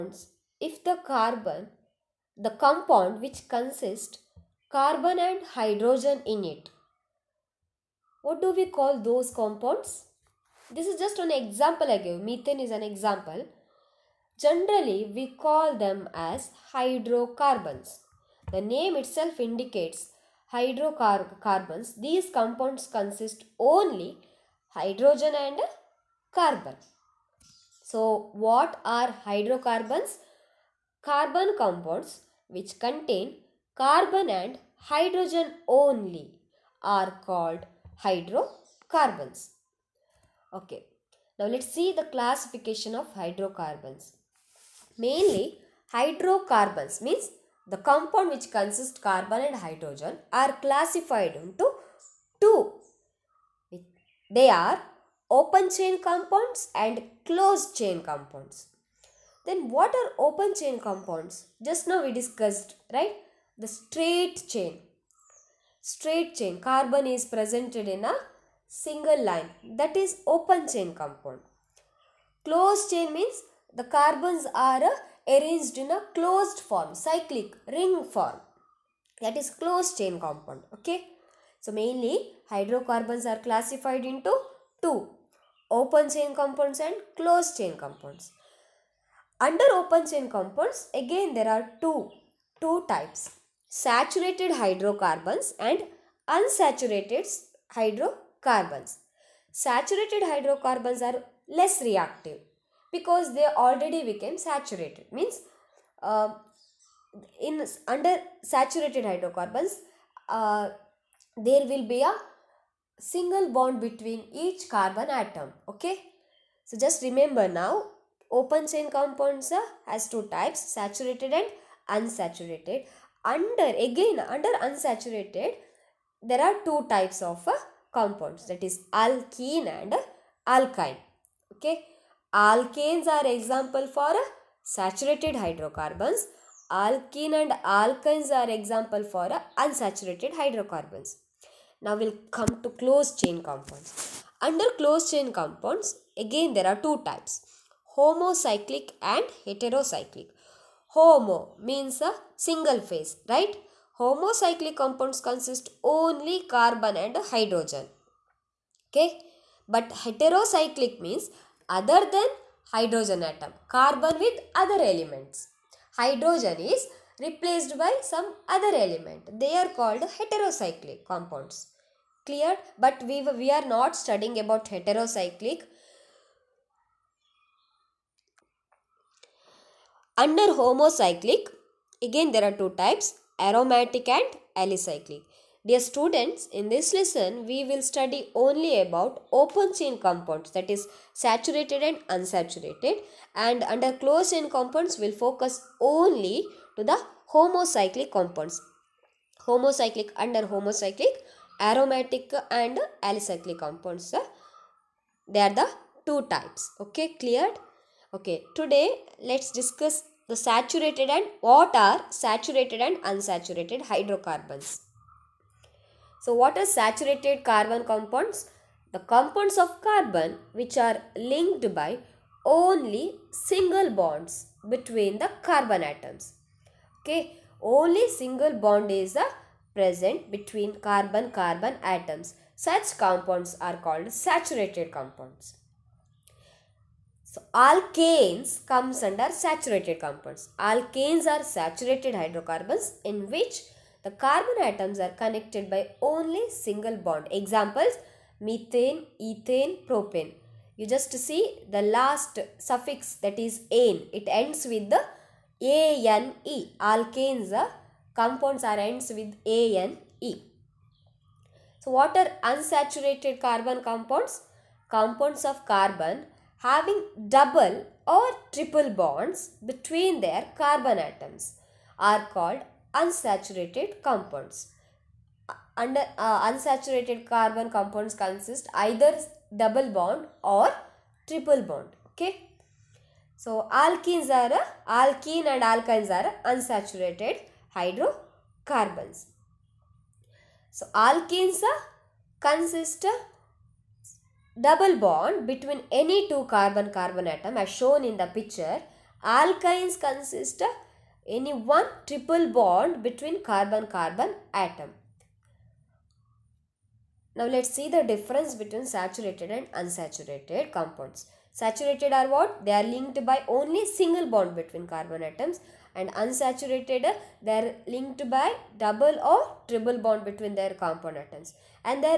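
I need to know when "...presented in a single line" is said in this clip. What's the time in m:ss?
1:07.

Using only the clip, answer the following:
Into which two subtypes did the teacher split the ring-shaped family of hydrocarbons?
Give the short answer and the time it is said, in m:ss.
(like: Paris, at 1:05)
Homocyclic and heterocyclic, at 2:27.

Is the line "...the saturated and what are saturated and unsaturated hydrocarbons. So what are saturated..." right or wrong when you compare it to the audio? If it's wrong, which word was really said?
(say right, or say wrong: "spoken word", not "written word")
right.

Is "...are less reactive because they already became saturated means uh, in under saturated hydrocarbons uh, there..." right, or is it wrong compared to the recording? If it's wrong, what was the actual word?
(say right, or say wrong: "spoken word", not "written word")
right.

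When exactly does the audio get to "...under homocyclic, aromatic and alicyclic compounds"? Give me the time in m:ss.
3:20.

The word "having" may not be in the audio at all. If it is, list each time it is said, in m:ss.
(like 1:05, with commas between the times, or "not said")
4:26.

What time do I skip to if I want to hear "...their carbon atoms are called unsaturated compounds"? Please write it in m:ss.
4:30.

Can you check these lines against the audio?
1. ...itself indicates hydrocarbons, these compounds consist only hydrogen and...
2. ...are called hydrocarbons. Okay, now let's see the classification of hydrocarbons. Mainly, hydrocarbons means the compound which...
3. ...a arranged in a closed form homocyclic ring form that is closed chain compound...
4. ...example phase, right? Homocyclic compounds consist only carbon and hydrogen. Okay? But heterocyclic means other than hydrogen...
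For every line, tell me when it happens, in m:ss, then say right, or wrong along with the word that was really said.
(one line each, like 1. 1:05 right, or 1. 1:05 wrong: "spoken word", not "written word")
1. 0:19 right
2. 0:36 right
3. 1:14 wrong: "cyclic", not "homocyclic"
4. 2:32 wrong: "single", not "example".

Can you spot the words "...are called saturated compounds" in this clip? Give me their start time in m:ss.
3:53.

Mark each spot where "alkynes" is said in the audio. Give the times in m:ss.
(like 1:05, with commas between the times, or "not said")
2:10, 2:17, 4:45, 4:59.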